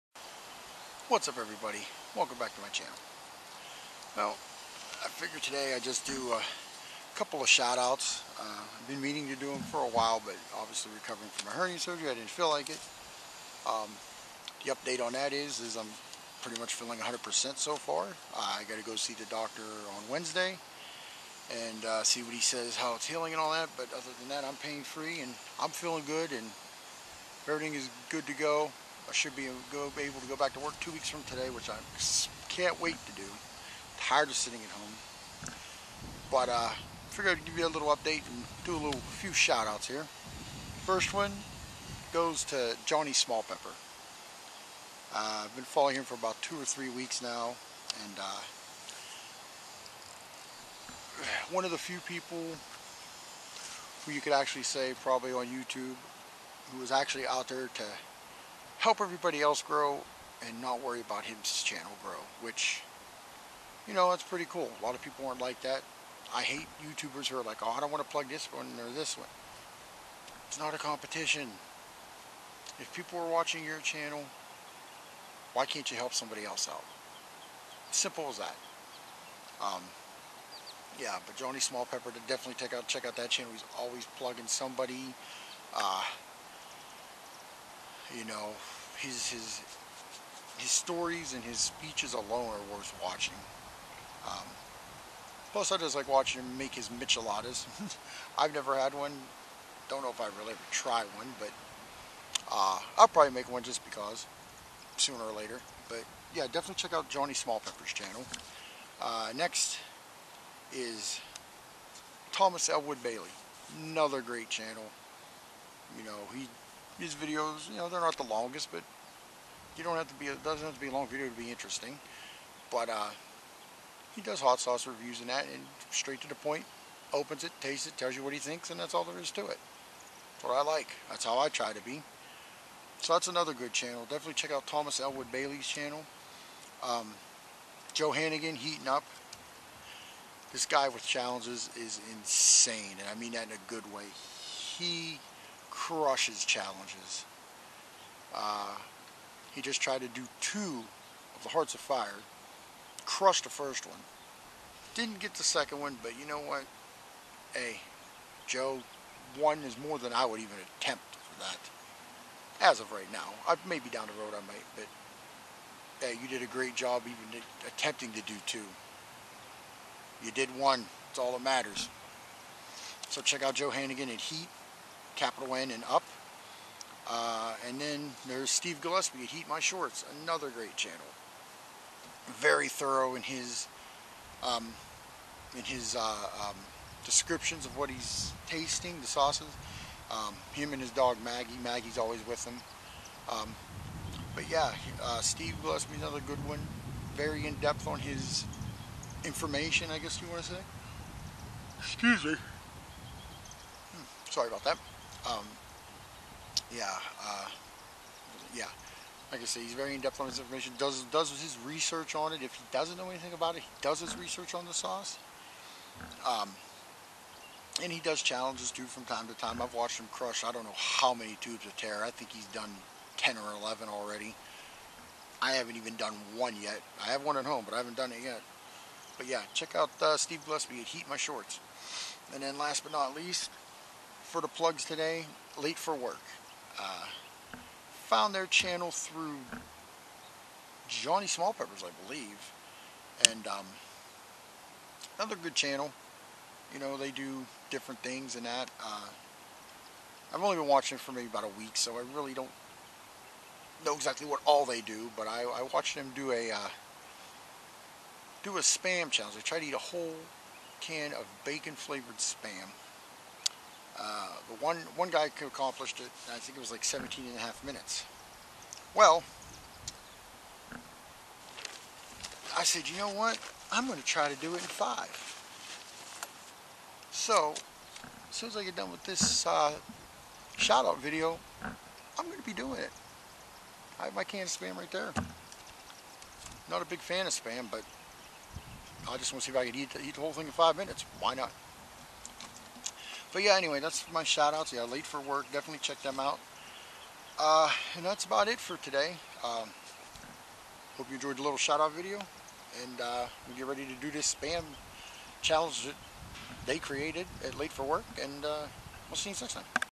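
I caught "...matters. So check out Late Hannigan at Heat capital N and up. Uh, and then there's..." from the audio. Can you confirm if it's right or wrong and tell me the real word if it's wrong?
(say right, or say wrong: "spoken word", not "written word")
wrong: "Joe", not "Late".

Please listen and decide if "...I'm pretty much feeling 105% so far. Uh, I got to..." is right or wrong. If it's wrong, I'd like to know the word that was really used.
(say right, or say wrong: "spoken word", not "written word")
wrong: "100", not "105".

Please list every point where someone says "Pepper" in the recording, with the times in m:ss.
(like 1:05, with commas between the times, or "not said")
0:43, 1:21, 1:47, 4:01.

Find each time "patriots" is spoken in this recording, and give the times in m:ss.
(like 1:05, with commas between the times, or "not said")
not said.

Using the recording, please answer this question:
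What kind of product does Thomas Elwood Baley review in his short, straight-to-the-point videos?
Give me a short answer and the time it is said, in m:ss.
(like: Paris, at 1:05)
hot sauce, at 2:04.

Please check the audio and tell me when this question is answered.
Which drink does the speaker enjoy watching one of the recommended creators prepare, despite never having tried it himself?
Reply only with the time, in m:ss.
1:36.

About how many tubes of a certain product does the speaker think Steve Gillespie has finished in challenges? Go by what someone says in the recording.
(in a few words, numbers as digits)
10 or 11.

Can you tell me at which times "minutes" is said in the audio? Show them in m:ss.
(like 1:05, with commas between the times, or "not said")
4:27, 4:50.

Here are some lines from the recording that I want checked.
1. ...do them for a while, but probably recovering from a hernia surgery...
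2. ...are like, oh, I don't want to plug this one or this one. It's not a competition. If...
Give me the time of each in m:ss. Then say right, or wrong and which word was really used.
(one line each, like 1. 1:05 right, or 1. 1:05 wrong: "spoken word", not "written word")
1. 0:09 wrong: "obviously", not "probably"
2. 1:07 right.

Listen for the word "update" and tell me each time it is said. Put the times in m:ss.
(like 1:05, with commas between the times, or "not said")
0:14, 0:37.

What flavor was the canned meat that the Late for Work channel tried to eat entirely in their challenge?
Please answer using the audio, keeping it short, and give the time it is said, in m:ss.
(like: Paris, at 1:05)
bacon, at 4:21.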